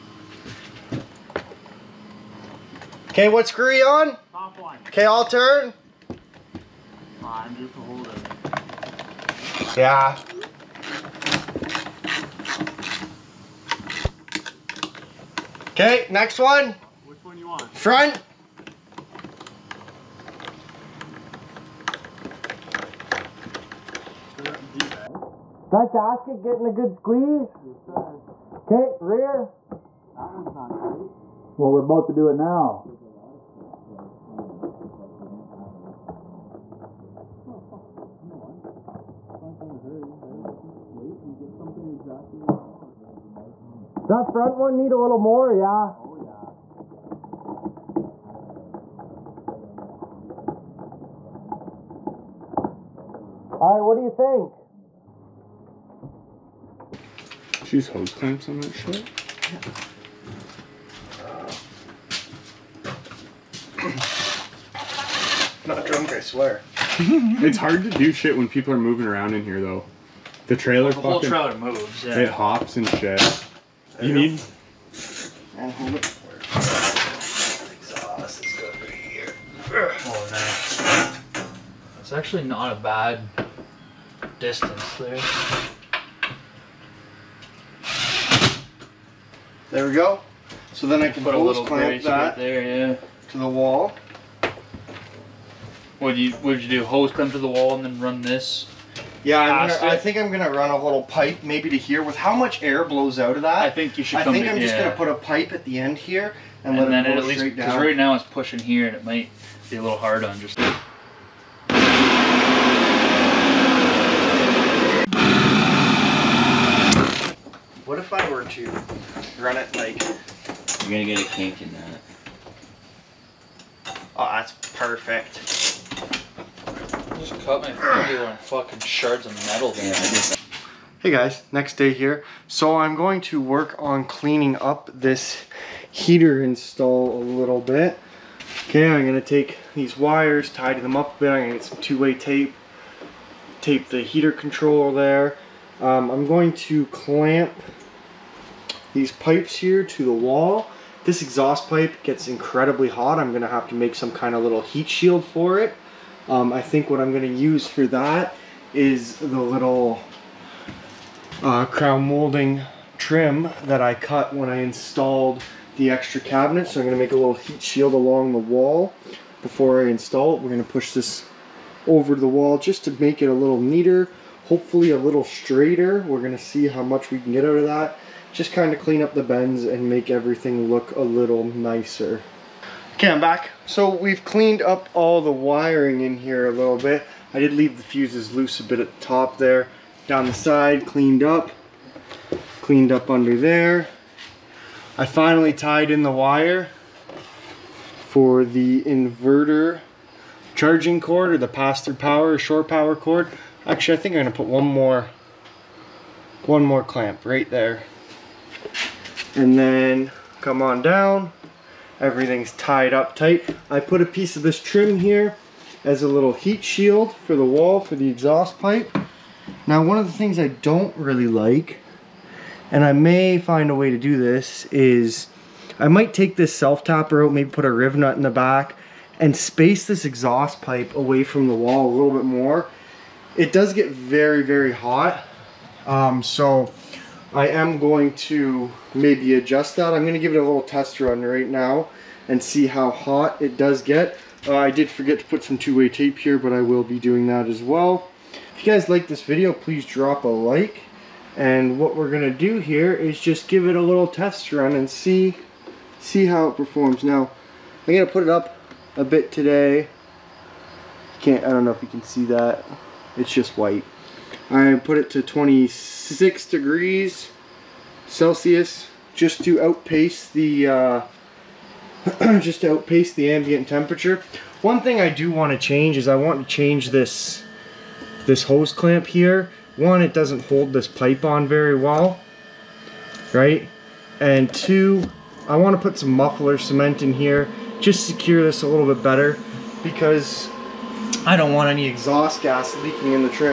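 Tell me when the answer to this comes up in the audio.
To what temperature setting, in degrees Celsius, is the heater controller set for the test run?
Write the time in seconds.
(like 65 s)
265 s.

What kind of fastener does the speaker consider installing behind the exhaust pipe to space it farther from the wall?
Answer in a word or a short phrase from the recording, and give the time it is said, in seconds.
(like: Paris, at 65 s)
riv nut, at 227 s.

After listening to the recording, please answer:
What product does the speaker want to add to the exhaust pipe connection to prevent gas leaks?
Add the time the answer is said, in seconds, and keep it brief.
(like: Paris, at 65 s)
muffler cement, at 286 s.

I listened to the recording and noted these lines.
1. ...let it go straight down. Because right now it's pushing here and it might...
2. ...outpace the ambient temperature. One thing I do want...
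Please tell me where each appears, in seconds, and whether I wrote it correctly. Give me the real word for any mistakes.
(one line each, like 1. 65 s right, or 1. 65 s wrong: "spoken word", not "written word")
1. 106 s right
2. 272 s right.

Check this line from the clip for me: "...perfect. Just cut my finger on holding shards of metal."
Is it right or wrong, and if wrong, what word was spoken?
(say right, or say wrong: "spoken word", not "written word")
wrong: "fucking", not "holding".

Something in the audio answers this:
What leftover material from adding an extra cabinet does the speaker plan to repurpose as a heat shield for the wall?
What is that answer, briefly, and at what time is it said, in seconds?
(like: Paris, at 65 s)
crown molding trim, at 161 s.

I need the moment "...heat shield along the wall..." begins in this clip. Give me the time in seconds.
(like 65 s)
167 s.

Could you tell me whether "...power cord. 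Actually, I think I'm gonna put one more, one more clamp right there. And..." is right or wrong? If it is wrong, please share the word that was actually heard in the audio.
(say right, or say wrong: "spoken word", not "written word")
right.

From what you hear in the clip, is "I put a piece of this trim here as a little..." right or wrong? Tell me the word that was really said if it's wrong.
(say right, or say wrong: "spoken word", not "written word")
right.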